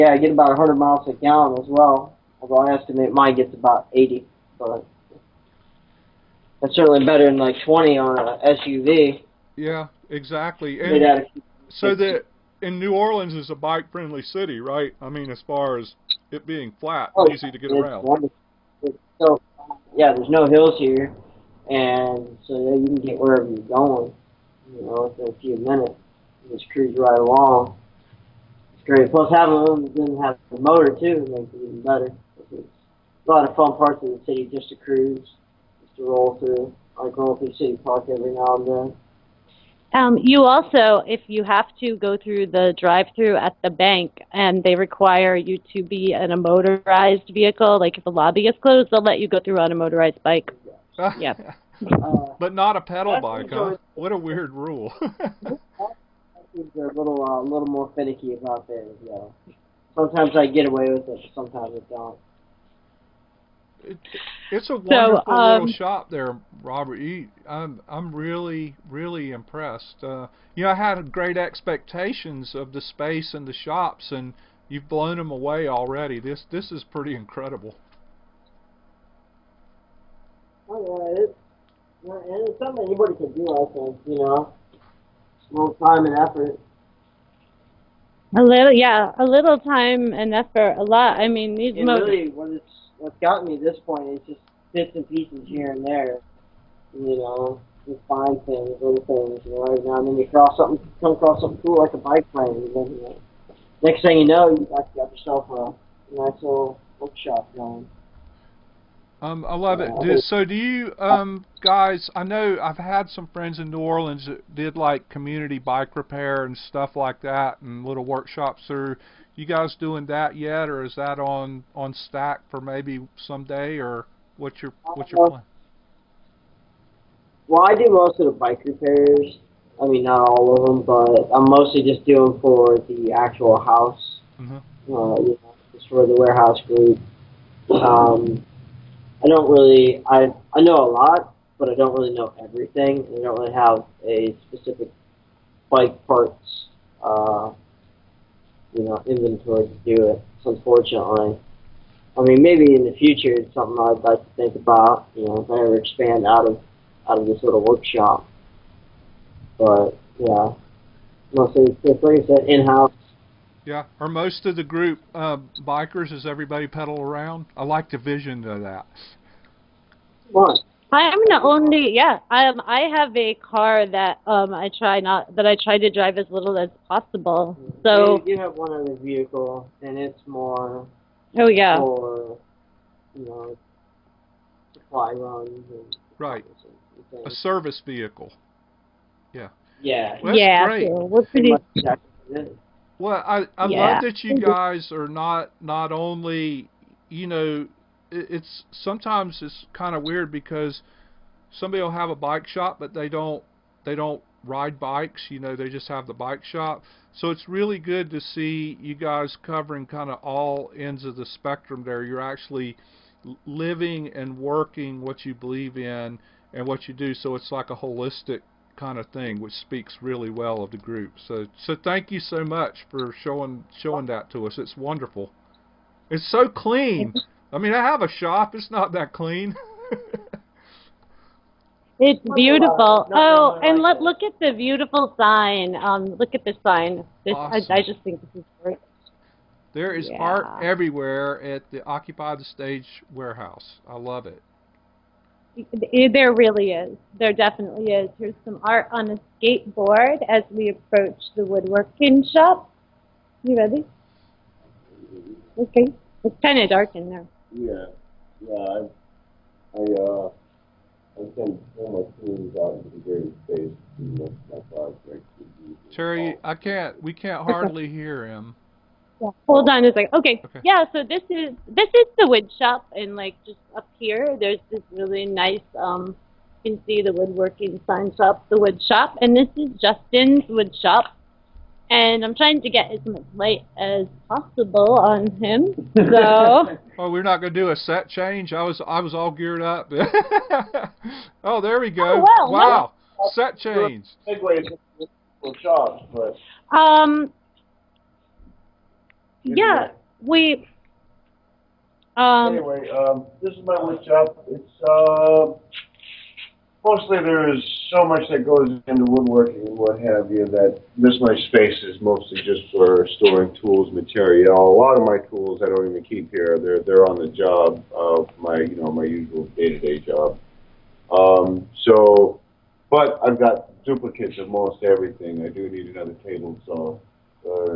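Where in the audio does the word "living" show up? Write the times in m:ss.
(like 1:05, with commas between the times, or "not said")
3:33.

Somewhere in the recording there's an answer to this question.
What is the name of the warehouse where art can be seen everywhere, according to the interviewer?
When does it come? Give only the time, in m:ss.
4:01.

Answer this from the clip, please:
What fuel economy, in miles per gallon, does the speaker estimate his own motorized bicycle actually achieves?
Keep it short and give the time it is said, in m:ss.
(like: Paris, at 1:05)
80, at 0:03.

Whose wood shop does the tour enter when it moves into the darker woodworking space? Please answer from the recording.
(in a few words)
Justin.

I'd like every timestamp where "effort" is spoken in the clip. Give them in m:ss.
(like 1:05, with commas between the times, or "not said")
1:26, 1:30.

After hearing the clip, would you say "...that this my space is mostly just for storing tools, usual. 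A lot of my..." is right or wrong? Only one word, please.
wrong.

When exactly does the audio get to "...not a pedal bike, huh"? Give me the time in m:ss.
0:52.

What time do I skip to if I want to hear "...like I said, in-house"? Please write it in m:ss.
2:41.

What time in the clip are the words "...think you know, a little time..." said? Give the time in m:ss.
1:23.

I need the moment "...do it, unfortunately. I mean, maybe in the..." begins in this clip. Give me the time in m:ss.
2:29.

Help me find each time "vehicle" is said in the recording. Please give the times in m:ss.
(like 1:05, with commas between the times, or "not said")
0:47, 2:58, 3:07.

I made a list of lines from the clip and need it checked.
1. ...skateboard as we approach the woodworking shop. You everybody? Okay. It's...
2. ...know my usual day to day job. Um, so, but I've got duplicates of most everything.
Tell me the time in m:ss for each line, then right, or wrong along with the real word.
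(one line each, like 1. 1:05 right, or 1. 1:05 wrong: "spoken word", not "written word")
1. 4:09 wrong: "ready", not "everybody"
2. 5:18 right.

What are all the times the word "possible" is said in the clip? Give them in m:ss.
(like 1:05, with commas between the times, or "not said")
2:56, 4:44.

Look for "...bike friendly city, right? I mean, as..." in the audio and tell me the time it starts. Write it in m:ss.
0:13.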